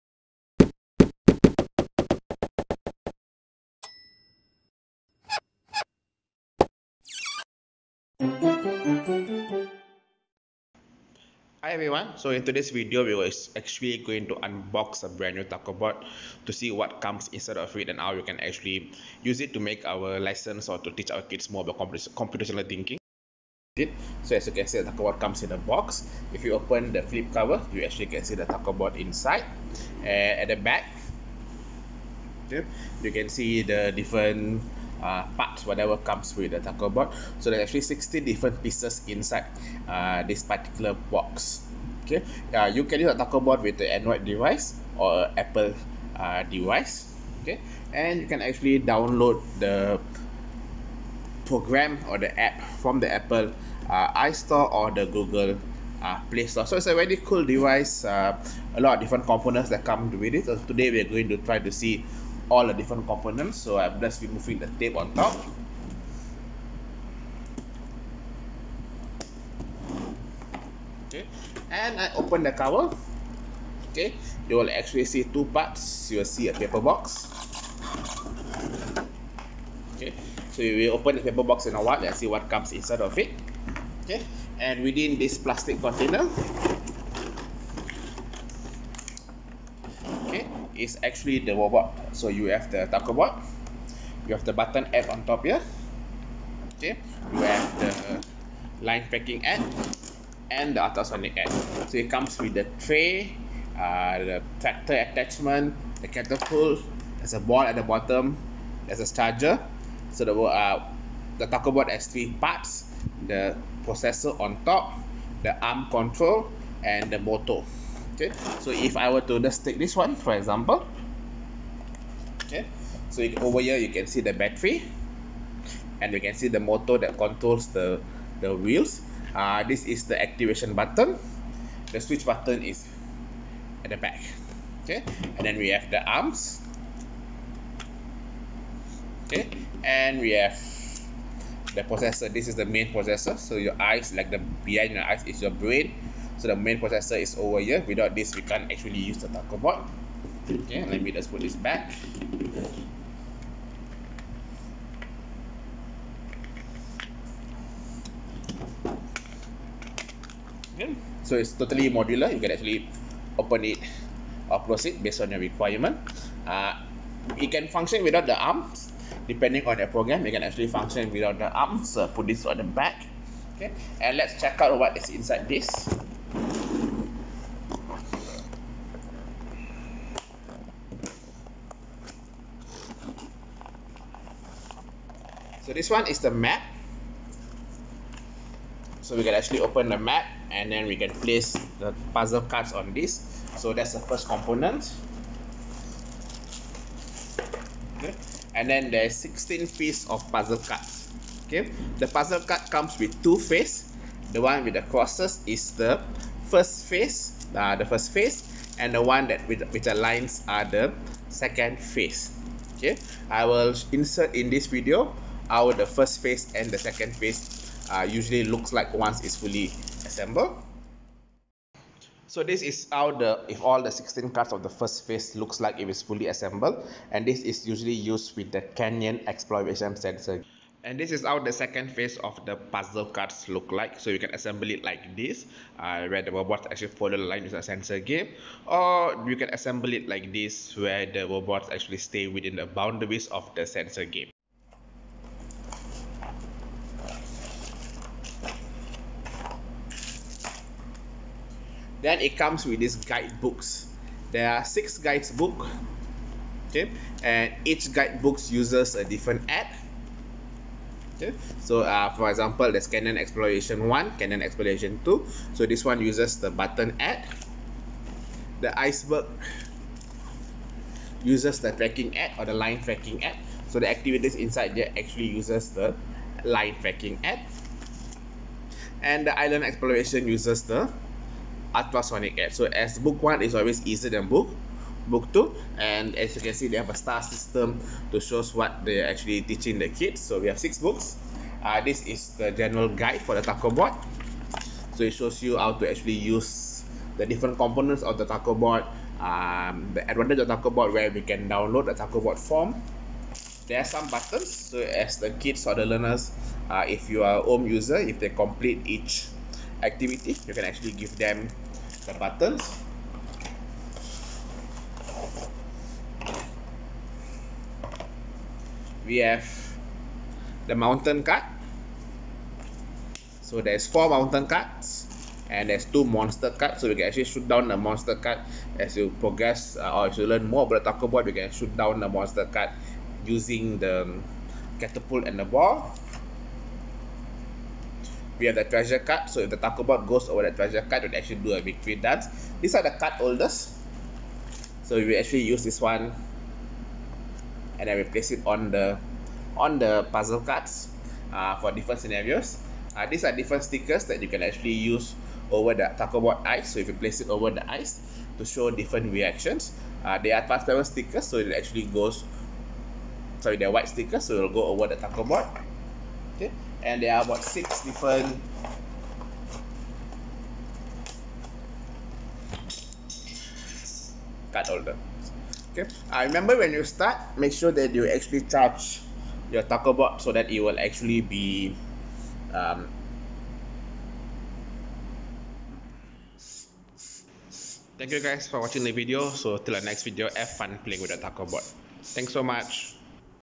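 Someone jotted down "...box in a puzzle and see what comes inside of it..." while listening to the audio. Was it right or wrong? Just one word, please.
wrong.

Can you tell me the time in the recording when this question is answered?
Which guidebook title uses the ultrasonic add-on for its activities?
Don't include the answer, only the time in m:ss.
4:39.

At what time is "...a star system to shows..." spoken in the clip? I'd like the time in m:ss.
4:46.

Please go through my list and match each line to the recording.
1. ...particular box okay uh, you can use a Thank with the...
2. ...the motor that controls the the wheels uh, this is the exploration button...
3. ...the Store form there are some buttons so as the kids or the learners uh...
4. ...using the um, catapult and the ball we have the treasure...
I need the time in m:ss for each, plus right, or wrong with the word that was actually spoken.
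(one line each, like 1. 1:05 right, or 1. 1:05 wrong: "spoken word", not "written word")
1. 0:40 wrong: "TacoBot", not "Thank"
2. 2:06 wrong: "activation", not "exploration"
3. 5:01 wrong: "TacoBot", not "Store"
4. 5:33 right.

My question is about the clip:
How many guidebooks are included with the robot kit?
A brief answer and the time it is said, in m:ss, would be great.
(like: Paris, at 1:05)
6, at 4:14.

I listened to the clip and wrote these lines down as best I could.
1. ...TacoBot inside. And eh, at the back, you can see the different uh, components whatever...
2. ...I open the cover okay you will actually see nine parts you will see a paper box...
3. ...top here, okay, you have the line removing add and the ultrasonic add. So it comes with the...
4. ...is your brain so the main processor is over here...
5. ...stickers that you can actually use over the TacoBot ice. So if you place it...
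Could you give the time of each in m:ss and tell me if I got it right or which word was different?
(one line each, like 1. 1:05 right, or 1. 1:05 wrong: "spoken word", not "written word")
1. 0:28 wrong: "parts", not "components"
2. 1:11 wrong: "two", not "nine"
3. 1:35 wrong: "packing", not "removing"
4. 2:25 right
5. 5:53 right.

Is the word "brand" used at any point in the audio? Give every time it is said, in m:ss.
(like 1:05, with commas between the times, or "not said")
0:15.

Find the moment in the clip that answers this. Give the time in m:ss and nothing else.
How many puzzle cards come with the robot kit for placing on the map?
3:19.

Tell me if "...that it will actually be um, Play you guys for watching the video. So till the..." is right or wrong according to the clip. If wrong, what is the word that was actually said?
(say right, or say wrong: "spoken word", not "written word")
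wrong: "Thank", not "Play".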